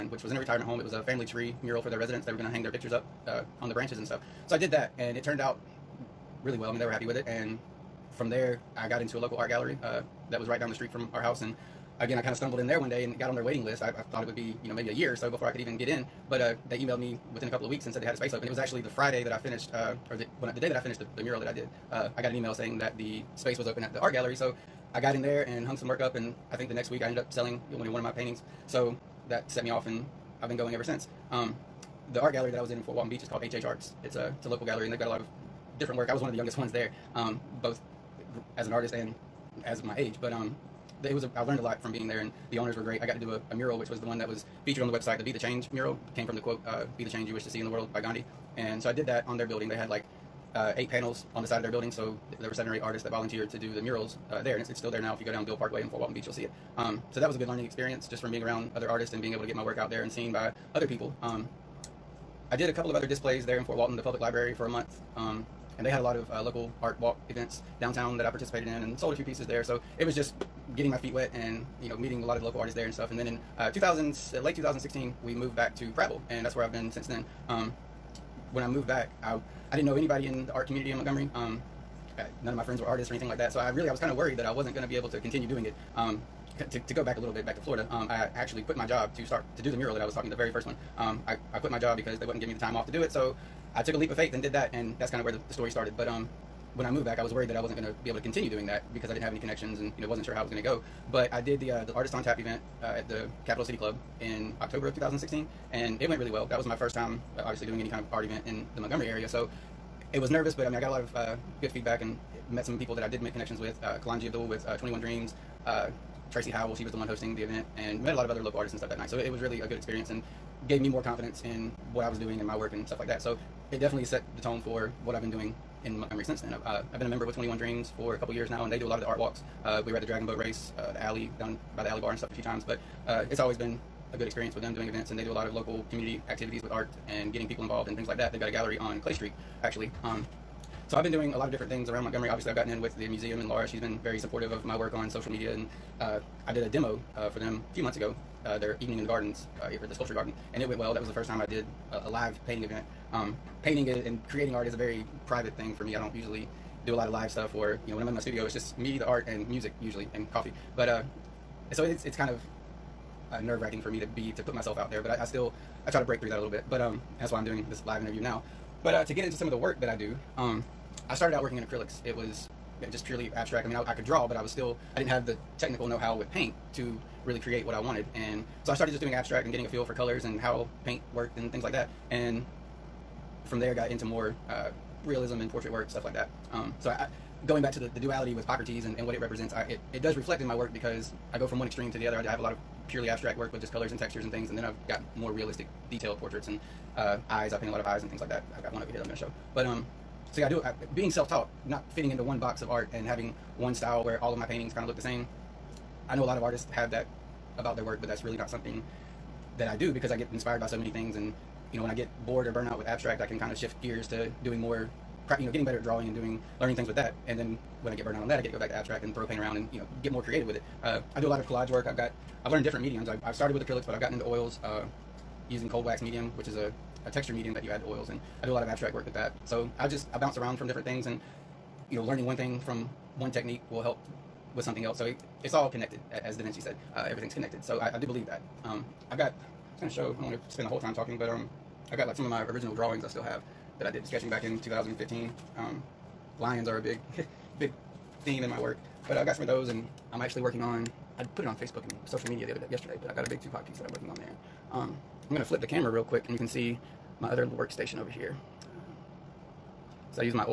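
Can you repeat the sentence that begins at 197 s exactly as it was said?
I paint a lot of eyes and things like that.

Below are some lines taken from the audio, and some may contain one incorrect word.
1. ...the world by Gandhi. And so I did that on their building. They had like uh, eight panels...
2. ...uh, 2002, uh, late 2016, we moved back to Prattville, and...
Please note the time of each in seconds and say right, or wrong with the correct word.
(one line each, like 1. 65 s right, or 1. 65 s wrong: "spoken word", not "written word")
1. 47 s right
2. 73 s wrong: "2000", not "2002".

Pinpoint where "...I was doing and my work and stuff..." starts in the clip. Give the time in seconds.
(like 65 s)
122 s.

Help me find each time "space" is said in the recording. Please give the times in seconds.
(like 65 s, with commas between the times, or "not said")
18 s, 23 s.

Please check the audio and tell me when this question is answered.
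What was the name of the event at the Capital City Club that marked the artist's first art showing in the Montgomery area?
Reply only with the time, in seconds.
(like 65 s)
101 s.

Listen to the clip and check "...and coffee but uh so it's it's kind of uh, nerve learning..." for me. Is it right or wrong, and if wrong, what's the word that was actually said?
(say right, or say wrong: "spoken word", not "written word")
wrong: "wracking", not "learning".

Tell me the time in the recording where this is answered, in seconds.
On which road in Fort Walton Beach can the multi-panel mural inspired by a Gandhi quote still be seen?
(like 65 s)
55 s.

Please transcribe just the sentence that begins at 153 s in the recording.
Um, painting and creating art is a very private thing for me.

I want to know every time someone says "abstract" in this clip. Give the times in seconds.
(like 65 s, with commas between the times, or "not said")
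173 s, 179 s, 193 s, 212 s, 218 s, 228 s.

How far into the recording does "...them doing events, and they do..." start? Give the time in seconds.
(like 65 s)
134 s.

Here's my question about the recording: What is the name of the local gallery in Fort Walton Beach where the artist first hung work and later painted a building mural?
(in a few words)
HH Arts.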